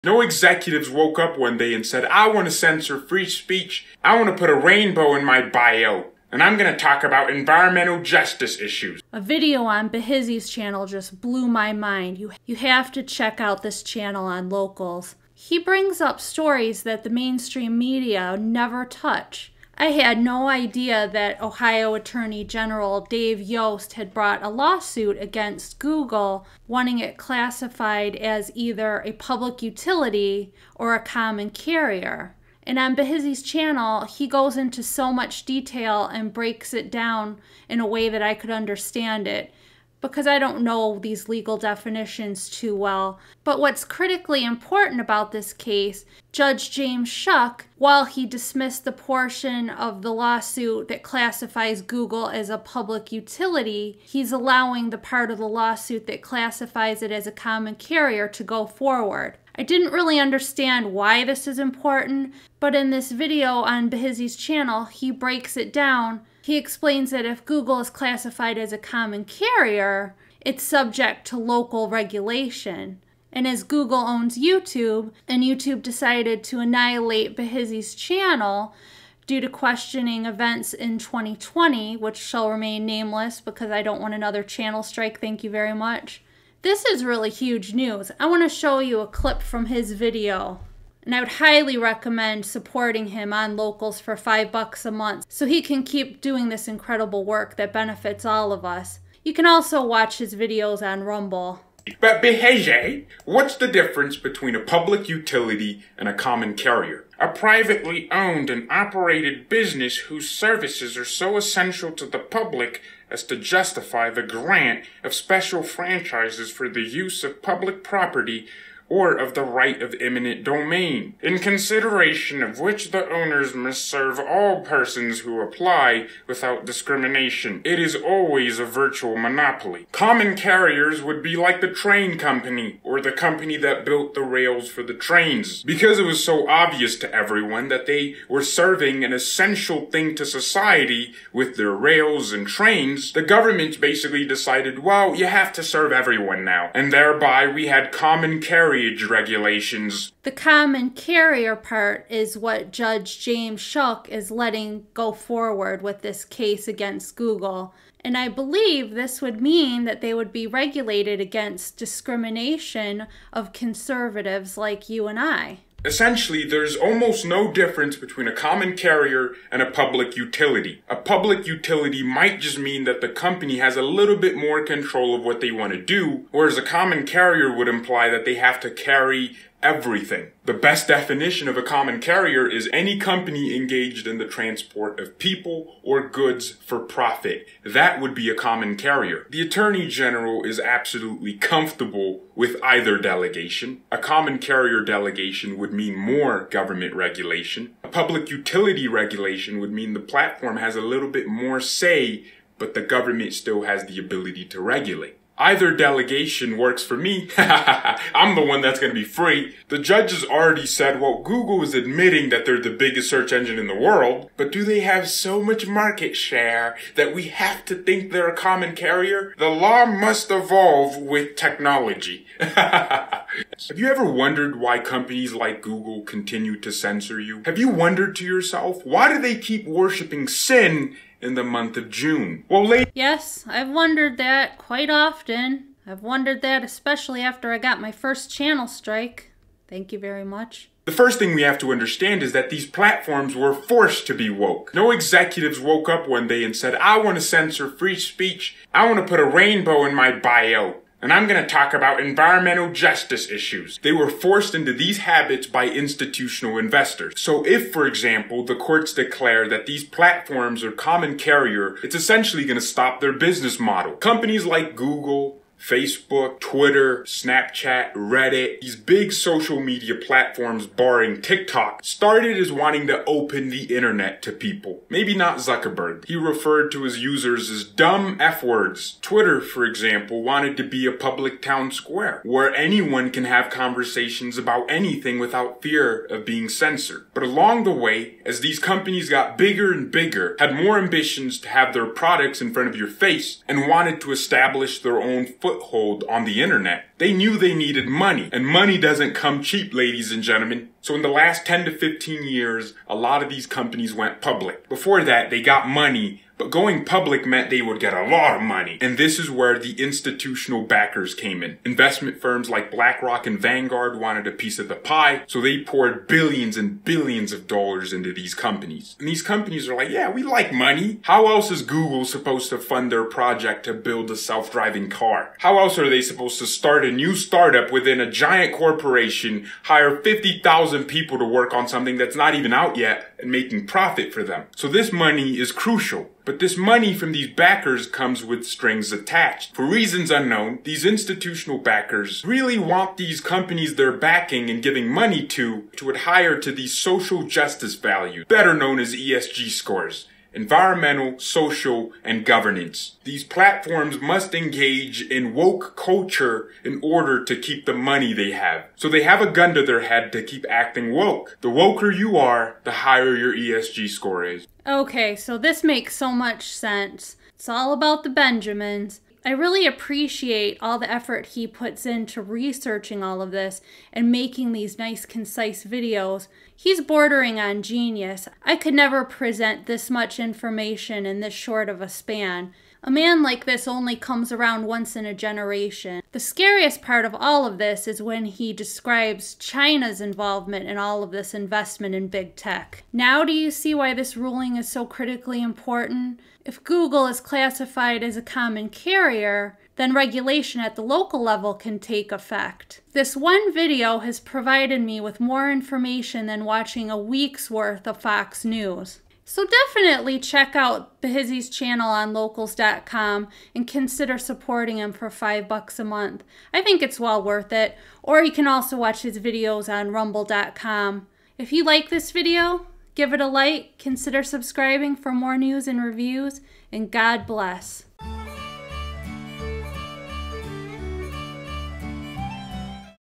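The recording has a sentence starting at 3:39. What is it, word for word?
The law must evolve with technology.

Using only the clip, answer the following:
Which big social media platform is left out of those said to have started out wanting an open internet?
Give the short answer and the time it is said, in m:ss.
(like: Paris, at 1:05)
TikTok, at 4:31.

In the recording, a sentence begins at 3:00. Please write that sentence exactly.
The best definition of a common carrier is any company engaged in the transport of people or goods for profit.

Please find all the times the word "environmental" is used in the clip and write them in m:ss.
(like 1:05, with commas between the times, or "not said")
0:07, 4:11, 5:50.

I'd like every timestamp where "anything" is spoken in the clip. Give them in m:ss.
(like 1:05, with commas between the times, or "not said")
4:44.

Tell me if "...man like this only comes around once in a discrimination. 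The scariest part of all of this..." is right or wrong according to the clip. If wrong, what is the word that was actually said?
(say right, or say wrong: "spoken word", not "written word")
wrong: "generation", not "discrimination".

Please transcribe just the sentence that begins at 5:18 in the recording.
And these companies are like, yeah, we like money.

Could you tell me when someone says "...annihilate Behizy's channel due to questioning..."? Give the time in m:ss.
1:16.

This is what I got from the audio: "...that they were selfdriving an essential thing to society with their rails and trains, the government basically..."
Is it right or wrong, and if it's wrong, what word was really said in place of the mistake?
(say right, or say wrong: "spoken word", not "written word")
wrong: "serving", not "selfdriving".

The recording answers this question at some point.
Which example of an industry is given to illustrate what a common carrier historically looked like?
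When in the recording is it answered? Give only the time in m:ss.
2:11.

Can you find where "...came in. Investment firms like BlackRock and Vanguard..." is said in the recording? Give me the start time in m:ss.
5:11.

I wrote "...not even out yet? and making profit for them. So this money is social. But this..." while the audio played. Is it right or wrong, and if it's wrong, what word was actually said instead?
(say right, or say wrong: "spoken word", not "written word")
wrong: "crucial", not "social".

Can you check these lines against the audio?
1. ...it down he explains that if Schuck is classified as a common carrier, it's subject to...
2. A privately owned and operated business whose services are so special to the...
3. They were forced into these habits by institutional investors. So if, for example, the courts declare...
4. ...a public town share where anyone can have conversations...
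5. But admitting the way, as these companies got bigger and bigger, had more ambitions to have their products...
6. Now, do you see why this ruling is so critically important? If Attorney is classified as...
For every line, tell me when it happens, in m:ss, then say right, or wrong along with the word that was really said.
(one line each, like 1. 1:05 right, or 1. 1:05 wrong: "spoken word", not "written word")
1. 1:05 wrong: "Google", not "Schuck"
2. 1:47 wrong: "essential", not "special"
3. 4:13 right
4. 4:40 wrong: "square", not "share"
5. 4:47 wrong: "along", not "admitting"
6. 6:32 wrong: "Google", not "Attorney".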